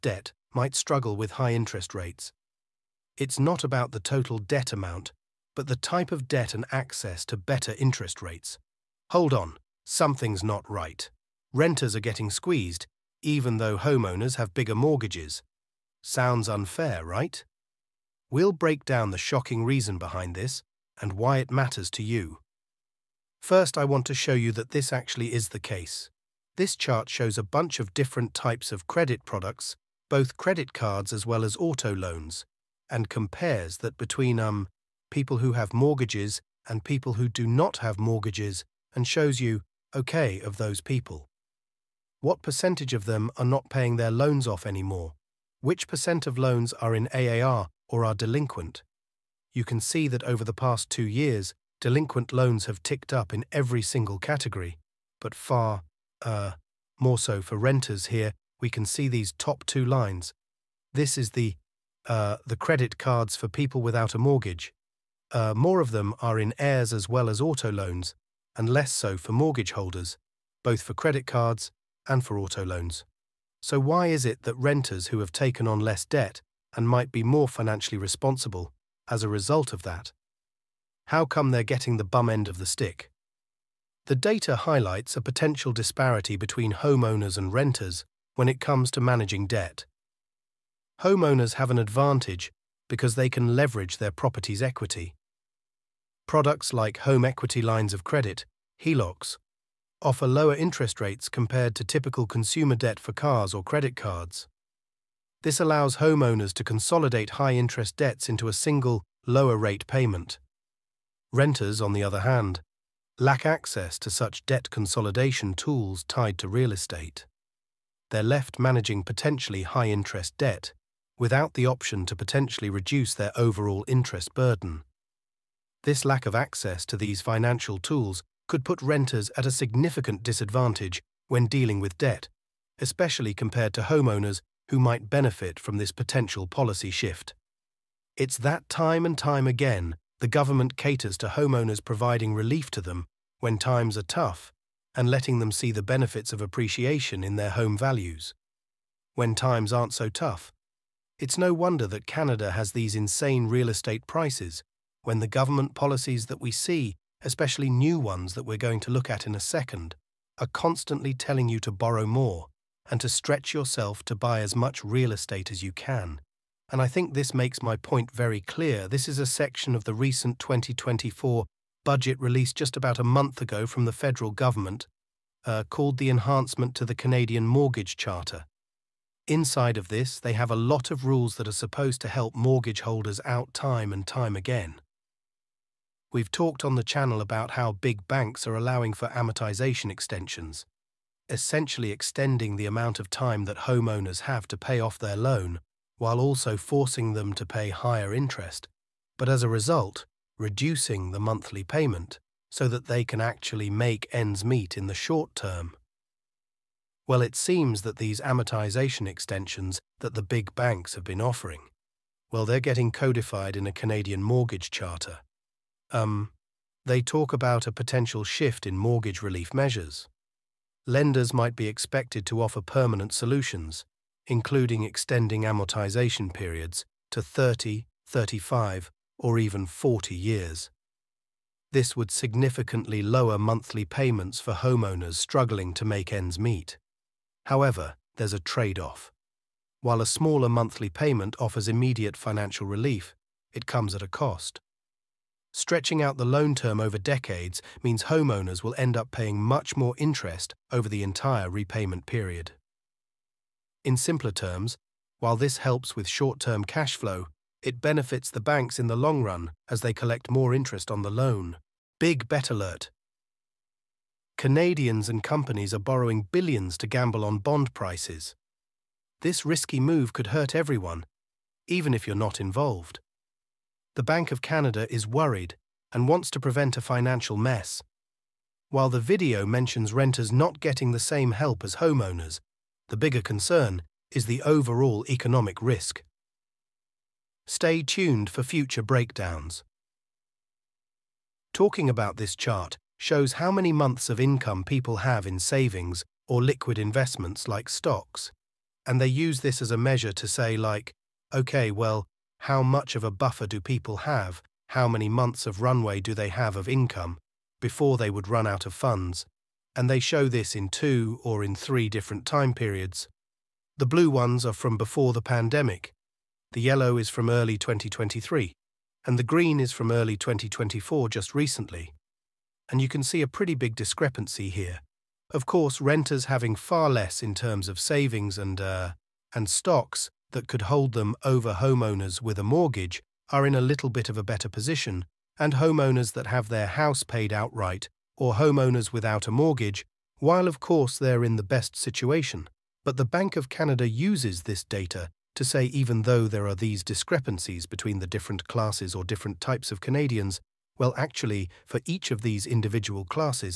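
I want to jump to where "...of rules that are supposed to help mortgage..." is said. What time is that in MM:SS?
03:00.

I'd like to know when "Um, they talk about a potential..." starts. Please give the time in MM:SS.
03:35.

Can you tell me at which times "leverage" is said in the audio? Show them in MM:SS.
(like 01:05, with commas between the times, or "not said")
01:33.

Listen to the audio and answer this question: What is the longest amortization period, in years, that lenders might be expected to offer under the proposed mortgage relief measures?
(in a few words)
40 years.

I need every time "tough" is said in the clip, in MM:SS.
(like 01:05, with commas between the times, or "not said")
02:24, 02:30.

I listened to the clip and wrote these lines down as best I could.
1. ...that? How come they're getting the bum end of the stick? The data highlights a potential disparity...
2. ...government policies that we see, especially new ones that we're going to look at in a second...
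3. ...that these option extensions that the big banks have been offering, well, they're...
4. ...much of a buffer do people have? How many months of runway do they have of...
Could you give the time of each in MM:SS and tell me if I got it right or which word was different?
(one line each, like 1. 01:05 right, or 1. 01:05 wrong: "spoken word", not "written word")
1. 01:19 right
2. 02:35 right
3. 03:27 wrong: "amortization", not "option"
4. 05:02 right.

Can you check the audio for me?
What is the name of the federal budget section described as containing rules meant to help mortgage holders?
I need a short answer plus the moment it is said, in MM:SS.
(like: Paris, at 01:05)
Enhancement to the Canadian Mortgage Charter, at 02:56.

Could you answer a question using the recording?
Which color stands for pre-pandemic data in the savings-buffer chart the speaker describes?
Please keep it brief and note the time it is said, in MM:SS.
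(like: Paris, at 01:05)
Blue, at 05:13.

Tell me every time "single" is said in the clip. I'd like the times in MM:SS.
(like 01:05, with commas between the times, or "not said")
00:53, 01:48.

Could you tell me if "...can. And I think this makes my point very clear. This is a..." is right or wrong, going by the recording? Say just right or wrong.
right.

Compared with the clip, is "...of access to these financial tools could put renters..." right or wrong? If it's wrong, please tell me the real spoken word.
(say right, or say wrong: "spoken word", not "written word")
right.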